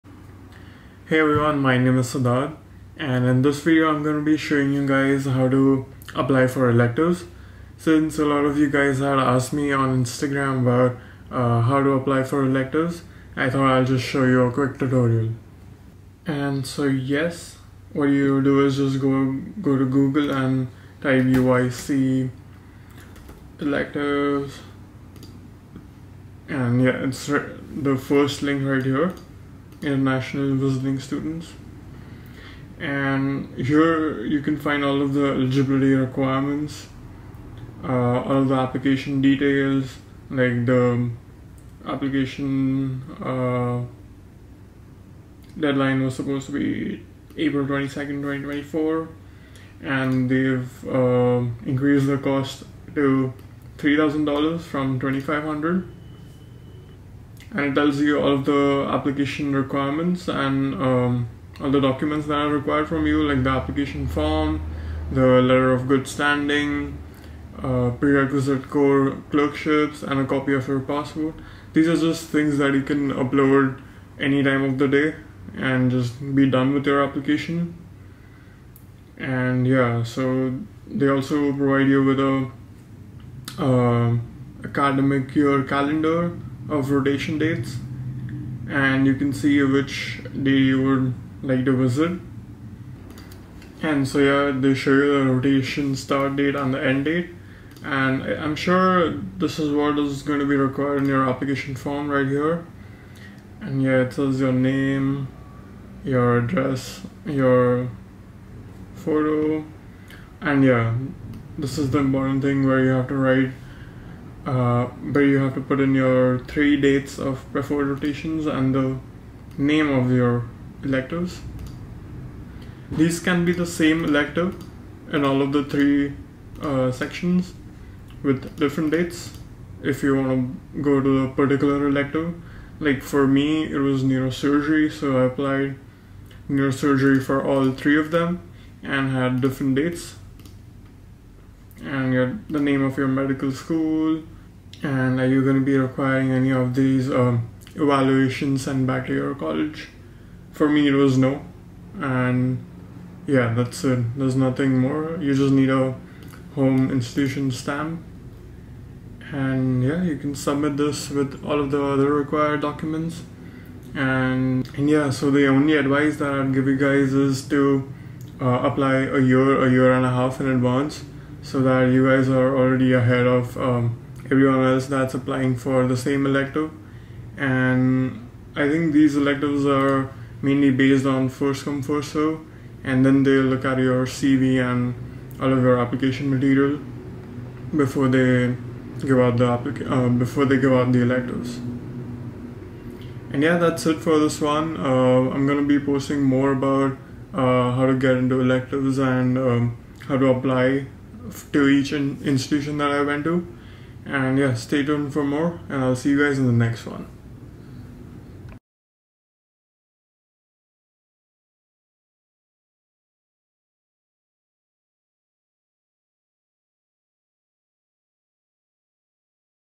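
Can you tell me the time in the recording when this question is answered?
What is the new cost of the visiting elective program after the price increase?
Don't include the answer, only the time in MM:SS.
00:53.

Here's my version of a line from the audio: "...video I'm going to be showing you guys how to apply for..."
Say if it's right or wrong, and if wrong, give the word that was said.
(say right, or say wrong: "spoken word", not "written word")
right.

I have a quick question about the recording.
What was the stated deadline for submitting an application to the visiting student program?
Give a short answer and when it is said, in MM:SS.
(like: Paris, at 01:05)
April 22nd, 2024, at 00:47.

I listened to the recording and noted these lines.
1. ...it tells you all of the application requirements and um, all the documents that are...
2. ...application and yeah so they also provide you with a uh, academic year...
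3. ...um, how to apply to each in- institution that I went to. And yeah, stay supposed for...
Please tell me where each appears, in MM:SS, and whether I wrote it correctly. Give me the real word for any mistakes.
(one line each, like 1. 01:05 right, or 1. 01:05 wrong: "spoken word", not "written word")
1. 00:57 right
2. 01:17 right
3. 03:19 wrong: "tuned", not "supposed".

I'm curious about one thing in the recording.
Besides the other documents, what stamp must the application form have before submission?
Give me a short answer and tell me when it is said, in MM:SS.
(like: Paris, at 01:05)
Home institution stamp, at 02:36.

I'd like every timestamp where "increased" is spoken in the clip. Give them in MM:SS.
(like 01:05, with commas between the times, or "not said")
00:51.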